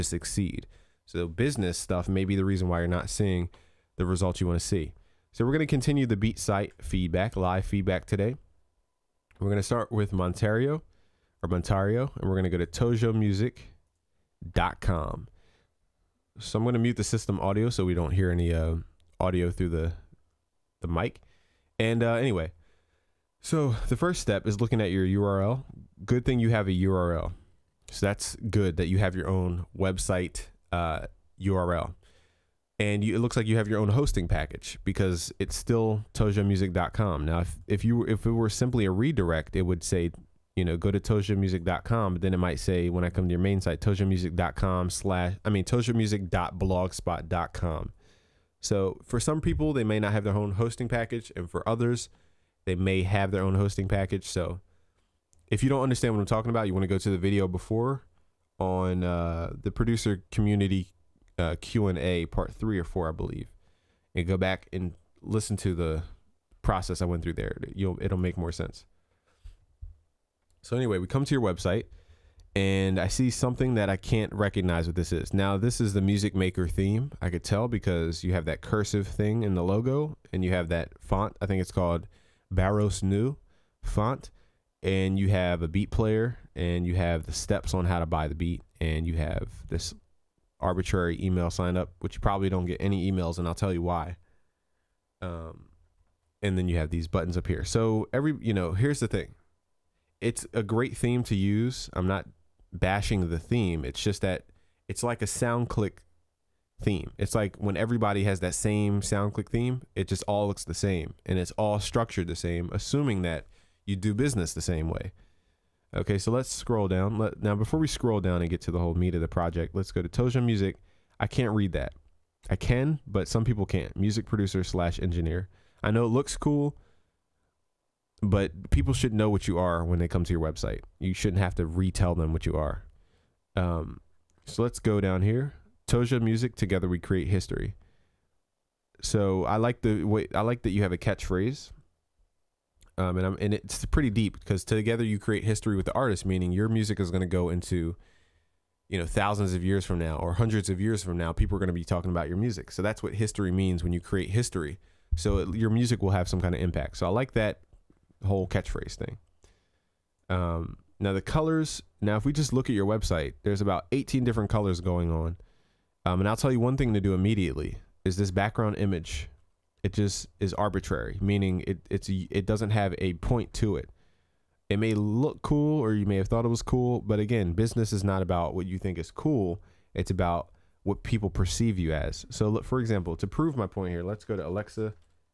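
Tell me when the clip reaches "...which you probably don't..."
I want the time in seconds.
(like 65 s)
91 s.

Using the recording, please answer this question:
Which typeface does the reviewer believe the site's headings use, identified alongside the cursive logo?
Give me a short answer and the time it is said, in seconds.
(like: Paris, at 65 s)
Bebas Neue, at 82 s.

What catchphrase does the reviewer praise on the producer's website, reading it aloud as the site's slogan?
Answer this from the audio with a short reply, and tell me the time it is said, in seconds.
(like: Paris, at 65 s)
Together we create history, at 136 s.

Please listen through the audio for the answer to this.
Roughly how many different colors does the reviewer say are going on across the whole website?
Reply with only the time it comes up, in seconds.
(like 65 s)
163 s.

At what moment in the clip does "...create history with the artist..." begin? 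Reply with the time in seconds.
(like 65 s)
145 s.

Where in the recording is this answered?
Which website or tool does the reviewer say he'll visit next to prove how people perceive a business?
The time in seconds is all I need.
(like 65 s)
184 s.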